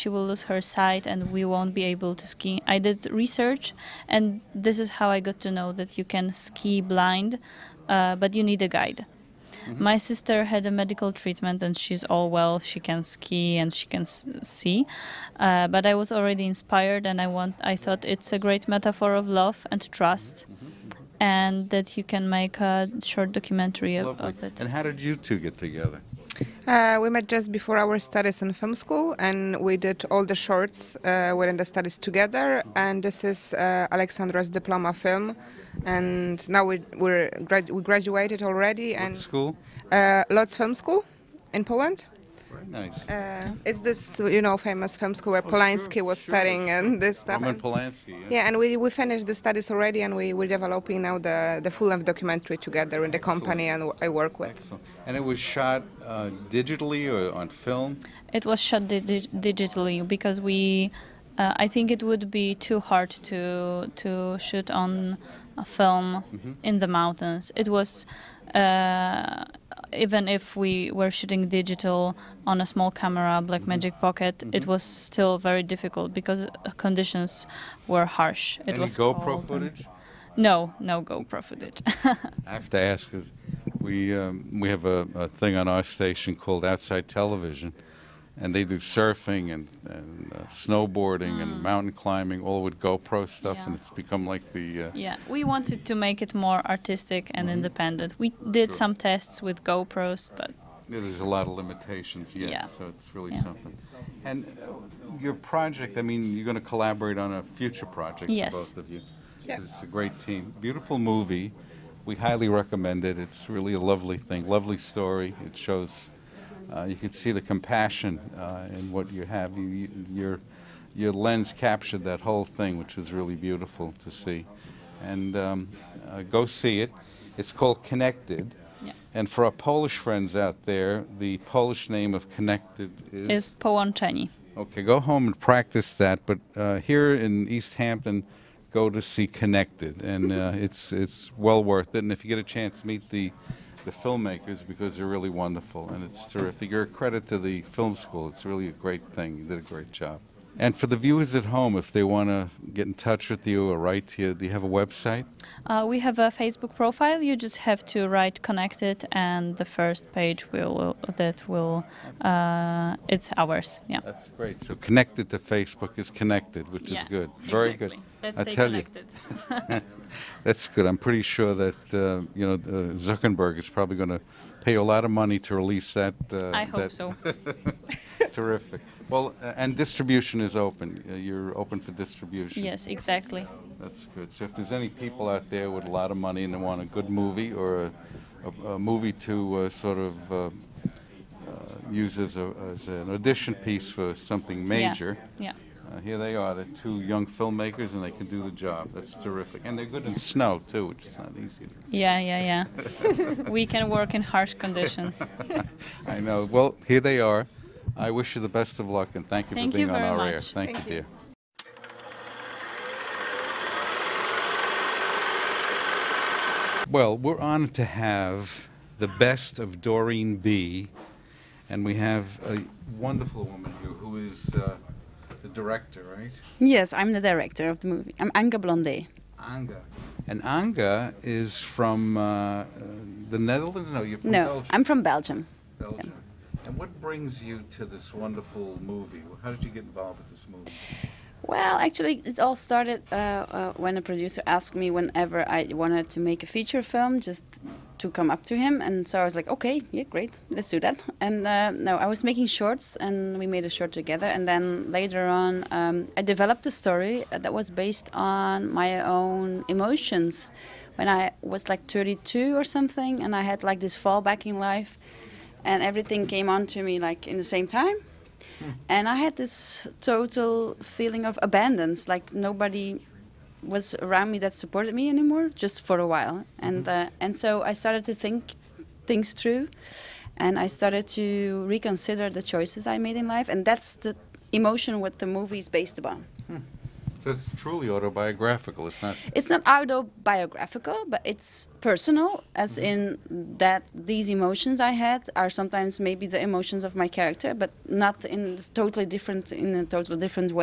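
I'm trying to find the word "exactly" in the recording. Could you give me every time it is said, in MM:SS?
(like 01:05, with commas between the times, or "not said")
02:47, 03:02.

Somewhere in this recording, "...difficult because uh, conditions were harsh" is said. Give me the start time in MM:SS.
01:15.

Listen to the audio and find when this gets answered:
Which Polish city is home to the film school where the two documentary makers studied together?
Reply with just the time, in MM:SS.
00:40.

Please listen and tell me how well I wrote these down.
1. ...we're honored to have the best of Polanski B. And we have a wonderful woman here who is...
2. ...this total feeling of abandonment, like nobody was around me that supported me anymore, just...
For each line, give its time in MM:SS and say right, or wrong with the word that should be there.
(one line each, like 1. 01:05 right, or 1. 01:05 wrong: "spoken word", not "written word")
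1. 03:37 wrong: "Dorien", not "Polanski"
2. 04:29 right.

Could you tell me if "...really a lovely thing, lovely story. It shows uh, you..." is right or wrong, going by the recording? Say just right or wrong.
right.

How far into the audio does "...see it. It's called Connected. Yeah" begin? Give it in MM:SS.
02:06.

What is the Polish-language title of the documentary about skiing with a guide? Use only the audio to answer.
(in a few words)
Połączeni.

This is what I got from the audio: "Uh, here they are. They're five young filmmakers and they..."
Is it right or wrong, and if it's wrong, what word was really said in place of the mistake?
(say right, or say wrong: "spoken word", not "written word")
wrong: "two", not "five".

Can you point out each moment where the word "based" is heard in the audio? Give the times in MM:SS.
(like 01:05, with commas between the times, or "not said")
04:17, 04:45.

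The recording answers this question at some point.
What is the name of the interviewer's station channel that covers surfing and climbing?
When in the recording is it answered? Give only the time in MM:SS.
01:26.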